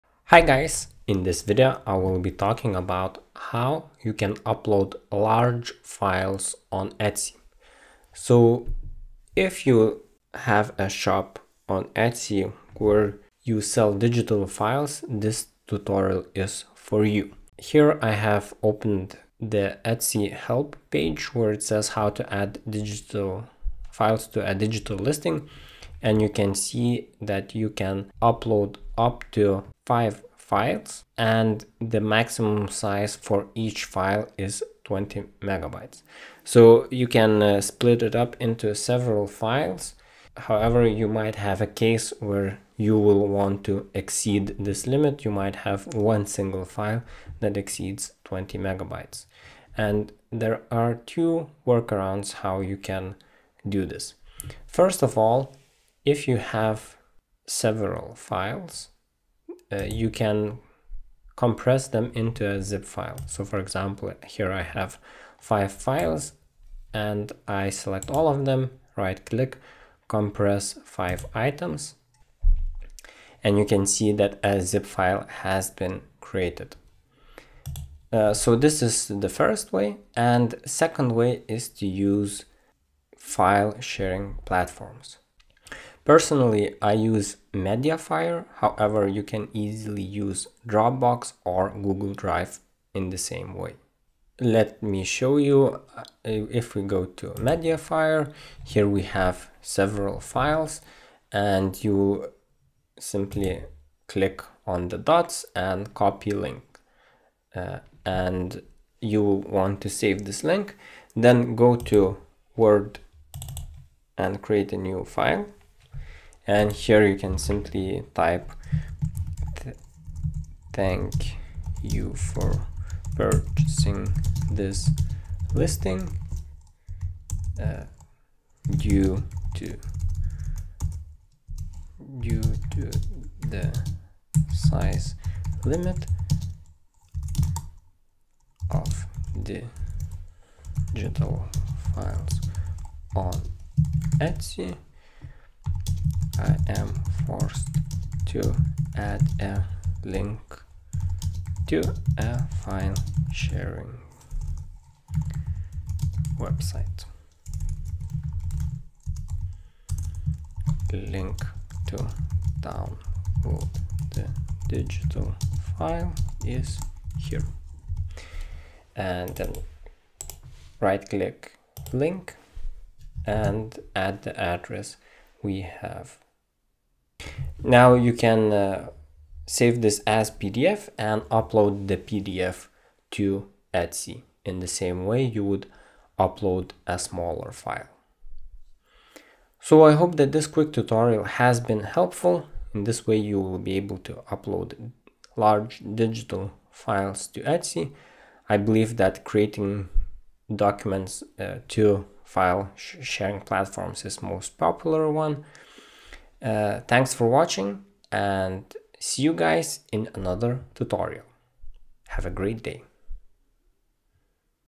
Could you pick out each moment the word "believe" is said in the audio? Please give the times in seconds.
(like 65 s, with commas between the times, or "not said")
198 s.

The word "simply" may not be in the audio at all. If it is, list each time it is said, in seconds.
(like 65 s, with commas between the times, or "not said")
102 s, 117 s.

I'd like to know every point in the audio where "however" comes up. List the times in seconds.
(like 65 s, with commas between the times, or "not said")
40 s, 88 s.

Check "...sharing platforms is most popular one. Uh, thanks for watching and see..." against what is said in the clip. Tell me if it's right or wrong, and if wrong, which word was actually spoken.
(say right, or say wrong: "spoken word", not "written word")
right.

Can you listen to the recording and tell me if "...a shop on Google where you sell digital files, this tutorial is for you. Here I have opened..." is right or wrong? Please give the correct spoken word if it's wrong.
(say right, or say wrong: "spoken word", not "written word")
wrong: "Etsy", not "Google".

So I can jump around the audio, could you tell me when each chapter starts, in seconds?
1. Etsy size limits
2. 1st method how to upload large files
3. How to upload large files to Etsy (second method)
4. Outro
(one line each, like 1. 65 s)
1. 17 s
2. 49 s
3. 79 s
4. 189 s.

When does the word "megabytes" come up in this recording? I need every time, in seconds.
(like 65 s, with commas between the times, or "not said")
35 s, 48 s.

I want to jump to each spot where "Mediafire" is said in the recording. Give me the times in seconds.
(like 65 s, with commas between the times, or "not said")
87 s, 97 s.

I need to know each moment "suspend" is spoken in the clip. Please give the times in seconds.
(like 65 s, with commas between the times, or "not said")
not said.